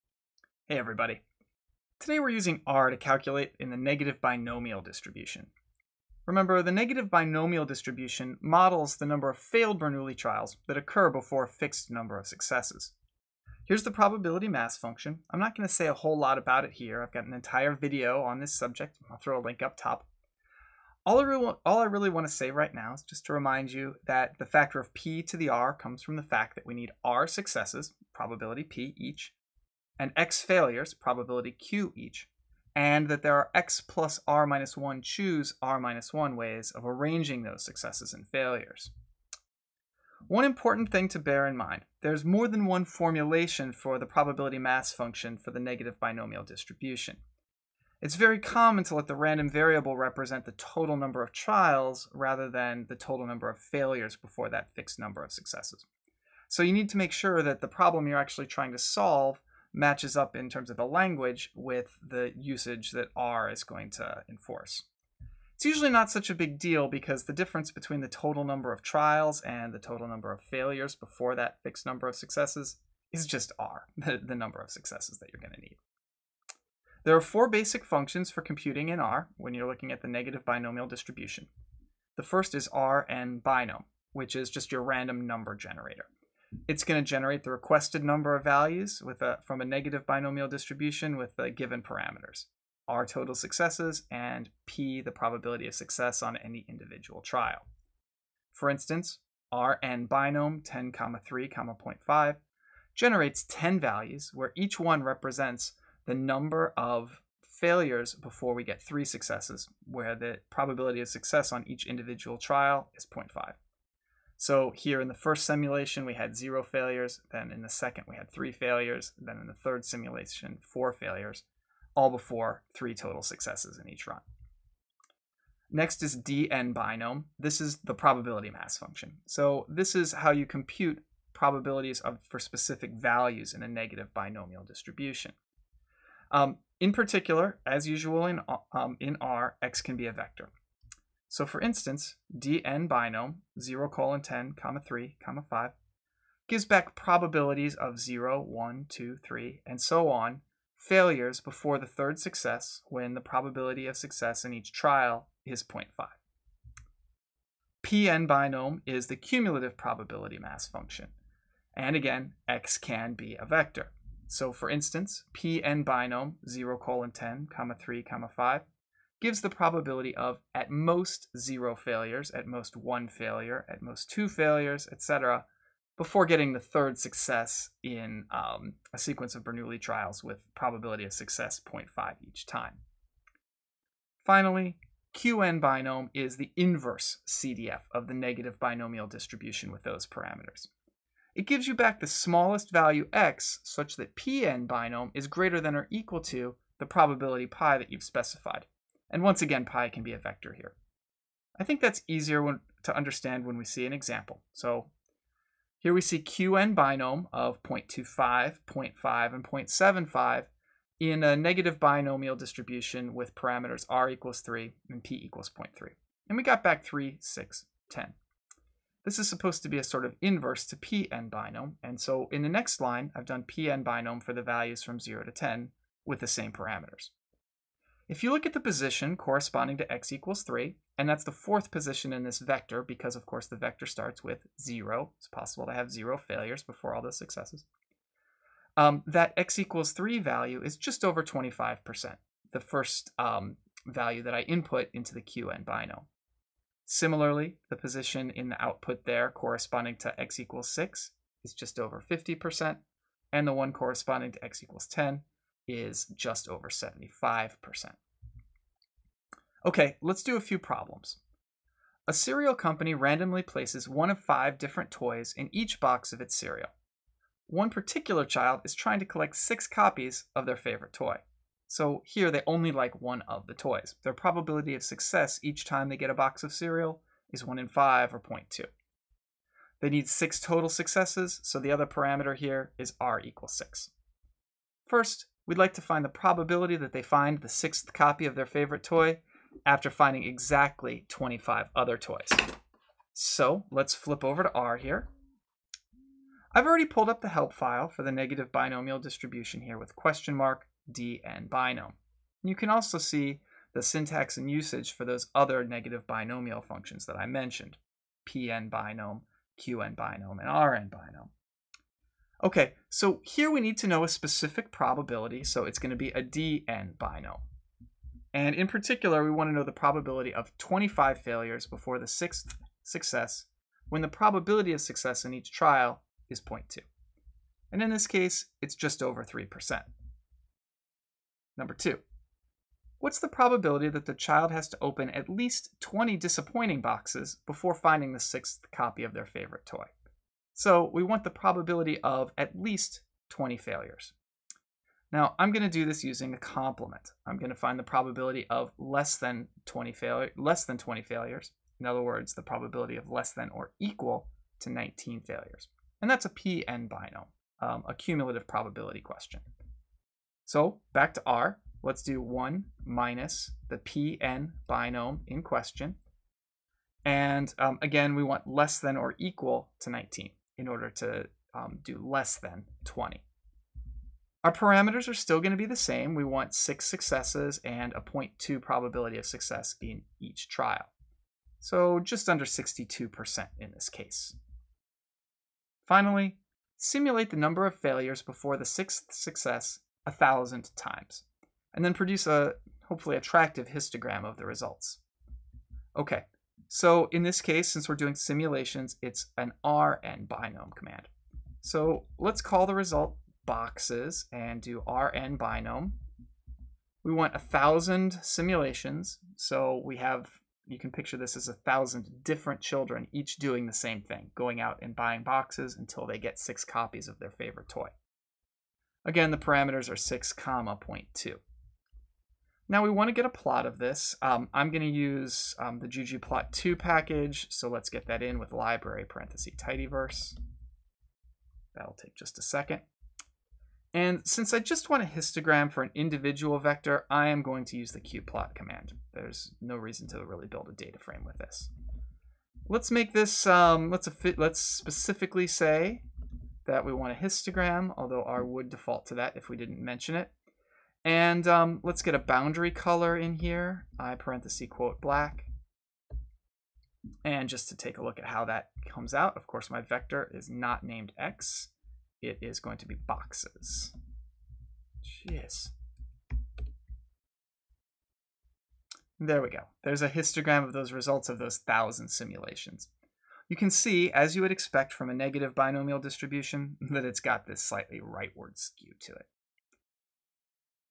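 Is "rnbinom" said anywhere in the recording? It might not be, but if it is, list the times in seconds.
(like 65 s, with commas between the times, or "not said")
82 s, 99 s, 310 s, 399 s, 404 s.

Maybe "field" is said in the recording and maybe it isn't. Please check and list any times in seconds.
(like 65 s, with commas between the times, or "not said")
not said.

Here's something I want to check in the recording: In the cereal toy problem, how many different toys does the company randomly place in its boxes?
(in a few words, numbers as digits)
5.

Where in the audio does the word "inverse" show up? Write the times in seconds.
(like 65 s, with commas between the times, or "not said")
186 s, 220 s.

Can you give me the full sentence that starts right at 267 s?
One particular child is trying to collect six copies of their favorite toy.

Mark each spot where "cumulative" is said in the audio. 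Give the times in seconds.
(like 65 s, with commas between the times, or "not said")
159 s, 357 s.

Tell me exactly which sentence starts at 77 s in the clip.
There are four basic functions for computing in R when you're looking at the negative binomial distribution.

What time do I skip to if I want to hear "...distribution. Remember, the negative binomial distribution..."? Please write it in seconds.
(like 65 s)
4 s.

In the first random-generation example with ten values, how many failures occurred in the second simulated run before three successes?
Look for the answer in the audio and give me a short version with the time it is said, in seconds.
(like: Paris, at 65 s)
3, at 118 s.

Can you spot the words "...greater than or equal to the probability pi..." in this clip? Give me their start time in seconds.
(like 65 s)
195 s.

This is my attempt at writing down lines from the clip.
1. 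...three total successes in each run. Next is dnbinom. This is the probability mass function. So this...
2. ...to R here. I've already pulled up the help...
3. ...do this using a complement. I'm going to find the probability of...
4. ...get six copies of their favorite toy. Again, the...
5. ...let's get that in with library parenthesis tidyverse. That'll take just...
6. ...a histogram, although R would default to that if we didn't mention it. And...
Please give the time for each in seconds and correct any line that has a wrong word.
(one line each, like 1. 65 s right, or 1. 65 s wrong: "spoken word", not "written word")
1. 122 s right
2. 294 s right
3. 345 s right
4. 416 s right
5. 427 s right
6. 447 s right.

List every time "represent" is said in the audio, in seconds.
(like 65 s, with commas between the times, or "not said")
49 s, 105 s.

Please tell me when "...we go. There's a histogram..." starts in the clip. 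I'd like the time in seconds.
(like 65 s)
469 s.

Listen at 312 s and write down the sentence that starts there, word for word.
Okay, so here we need to know a specific probability, so it's going to be a dn binomial.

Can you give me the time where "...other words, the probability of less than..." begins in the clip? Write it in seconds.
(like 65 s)
351 s.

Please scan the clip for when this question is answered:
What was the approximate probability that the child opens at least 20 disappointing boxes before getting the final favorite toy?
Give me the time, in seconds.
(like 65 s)
381 s.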